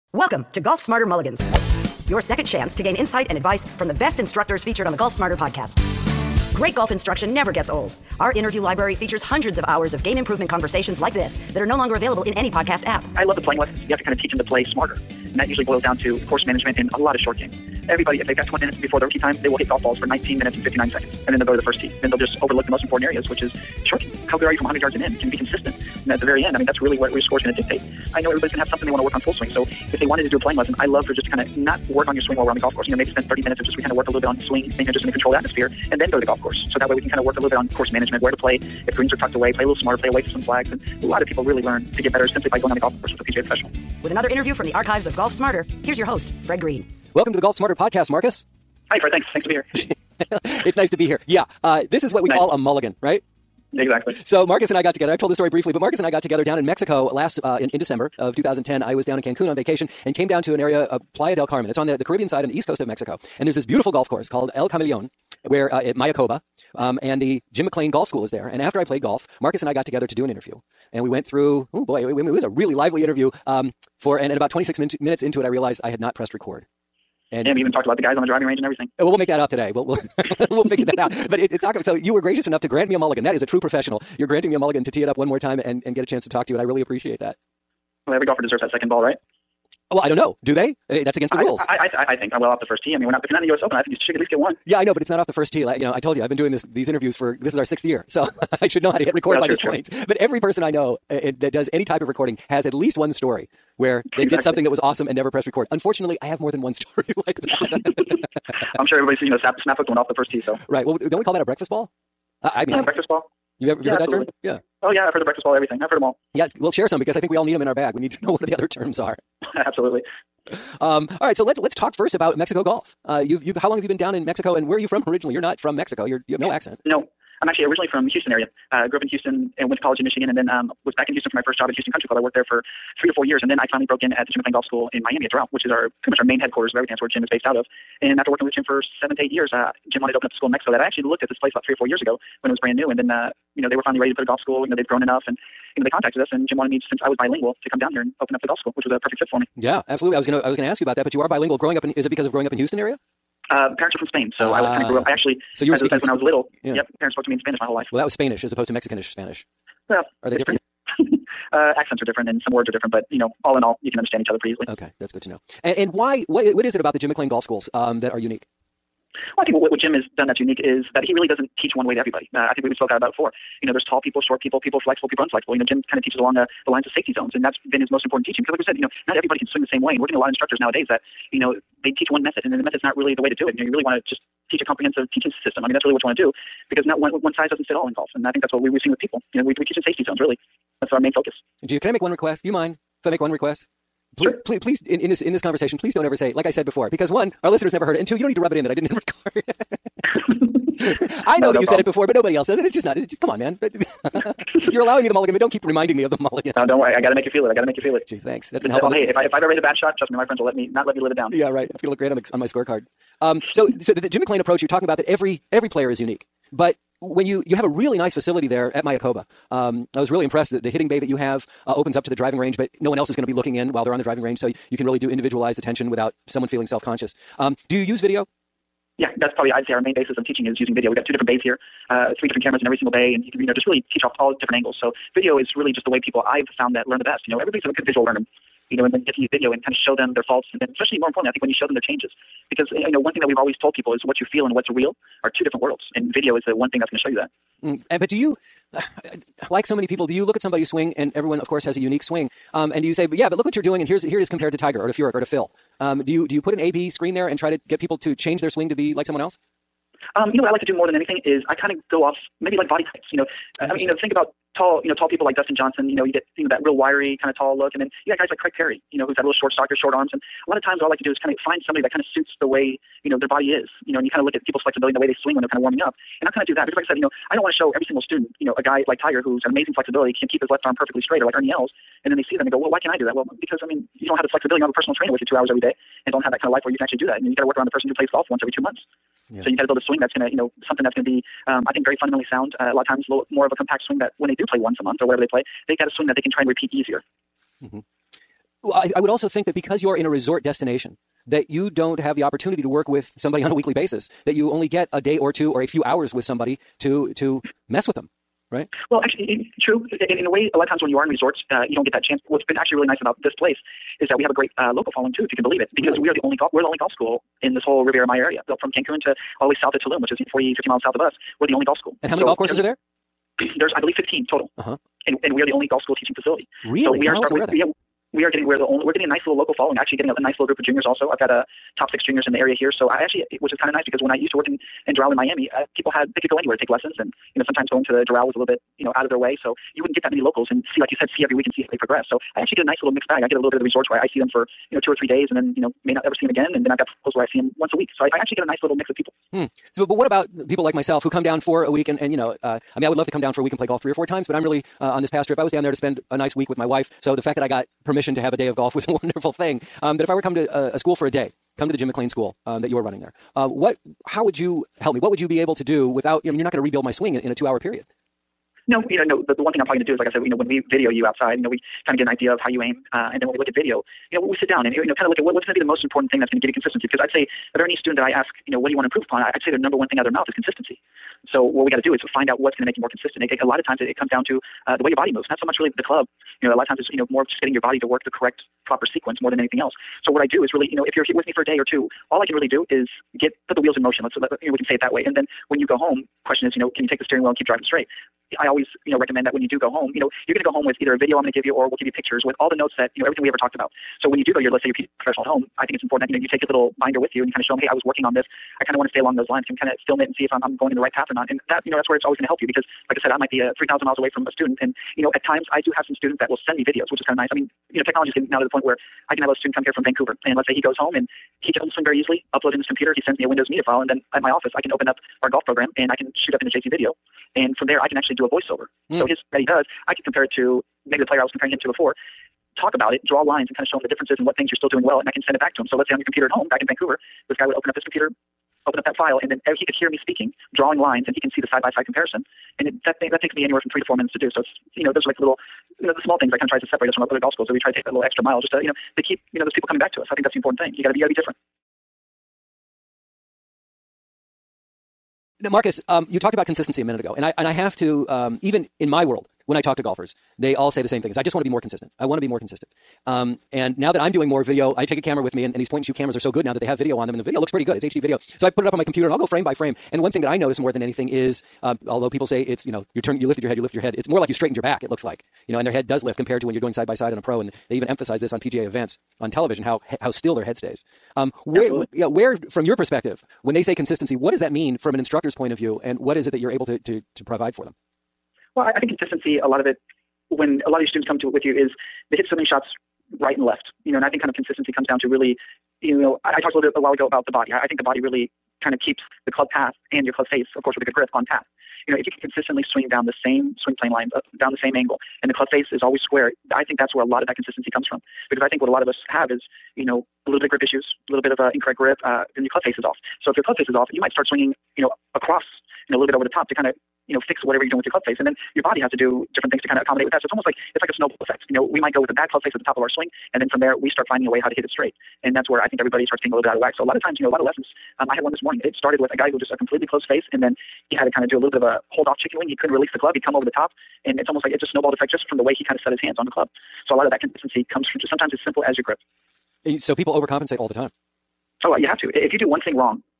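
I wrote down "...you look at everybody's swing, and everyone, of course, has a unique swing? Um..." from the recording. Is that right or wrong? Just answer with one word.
wrong.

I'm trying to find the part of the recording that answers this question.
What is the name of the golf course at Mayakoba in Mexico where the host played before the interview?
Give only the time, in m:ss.
1:04.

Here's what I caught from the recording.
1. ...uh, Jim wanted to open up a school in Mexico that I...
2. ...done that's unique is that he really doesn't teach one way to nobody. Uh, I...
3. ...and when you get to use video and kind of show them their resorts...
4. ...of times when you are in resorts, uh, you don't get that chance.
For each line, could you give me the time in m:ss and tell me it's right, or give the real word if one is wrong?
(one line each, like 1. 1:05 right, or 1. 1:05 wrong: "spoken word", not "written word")
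1. 2:19 right
2. 2:50 wrong: "everybody", not "nobody"
3. 3:58 wrong: "faults", not "resorts"
4. 5:10 right.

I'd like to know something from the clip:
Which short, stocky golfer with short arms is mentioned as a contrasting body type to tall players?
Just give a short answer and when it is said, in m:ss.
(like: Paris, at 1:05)
Craig Parry, at 4:28.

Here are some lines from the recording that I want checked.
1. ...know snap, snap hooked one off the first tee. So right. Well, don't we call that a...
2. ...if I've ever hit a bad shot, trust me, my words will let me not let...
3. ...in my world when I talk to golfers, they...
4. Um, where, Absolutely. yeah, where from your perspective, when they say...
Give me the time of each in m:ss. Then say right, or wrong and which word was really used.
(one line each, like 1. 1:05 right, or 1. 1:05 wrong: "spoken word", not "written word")
1. 1:49 right
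2. 3:29 wrong: "friends", not "words"
3. 7:38 right
4. 8:01 right.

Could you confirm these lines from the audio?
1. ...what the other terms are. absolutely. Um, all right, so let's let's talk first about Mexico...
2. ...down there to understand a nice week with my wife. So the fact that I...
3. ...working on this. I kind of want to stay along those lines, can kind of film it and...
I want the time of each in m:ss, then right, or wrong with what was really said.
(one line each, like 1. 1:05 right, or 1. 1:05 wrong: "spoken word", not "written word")
1. 1:58 right
2. 5:55 wrong: "spend", not "understand"
3. 6:47 right.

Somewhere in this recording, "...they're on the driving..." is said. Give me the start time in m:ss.
3:43.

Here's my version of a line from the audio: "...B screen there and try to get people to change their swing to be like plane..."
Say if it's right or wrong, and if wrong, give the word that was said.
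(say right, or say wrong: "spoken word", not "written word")
wrong: "someone", not "plane".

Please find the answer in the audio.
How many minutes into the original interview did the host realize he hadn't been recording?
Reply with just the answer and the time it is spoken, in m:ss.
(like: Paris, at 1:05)
26, at 1:14.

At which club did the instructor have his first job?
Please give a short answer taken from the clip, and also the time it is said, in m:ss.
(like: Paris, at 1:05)
Houston Country Club, at 2:11.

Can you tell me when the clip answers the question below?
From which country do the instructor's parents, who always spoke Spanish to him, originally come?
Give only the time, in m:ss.
2:34.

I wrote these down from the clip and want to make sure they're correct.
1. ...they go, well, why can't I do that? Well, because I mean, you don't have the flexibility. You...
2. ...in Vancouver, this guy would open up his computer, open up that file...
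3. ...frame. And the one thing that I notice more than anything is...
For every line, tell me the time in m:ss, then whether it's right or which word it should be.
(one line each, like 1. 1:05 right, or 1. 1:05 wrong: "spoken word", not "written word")
1. 4:42 right
2. 7:16 right
3. 7:49 right.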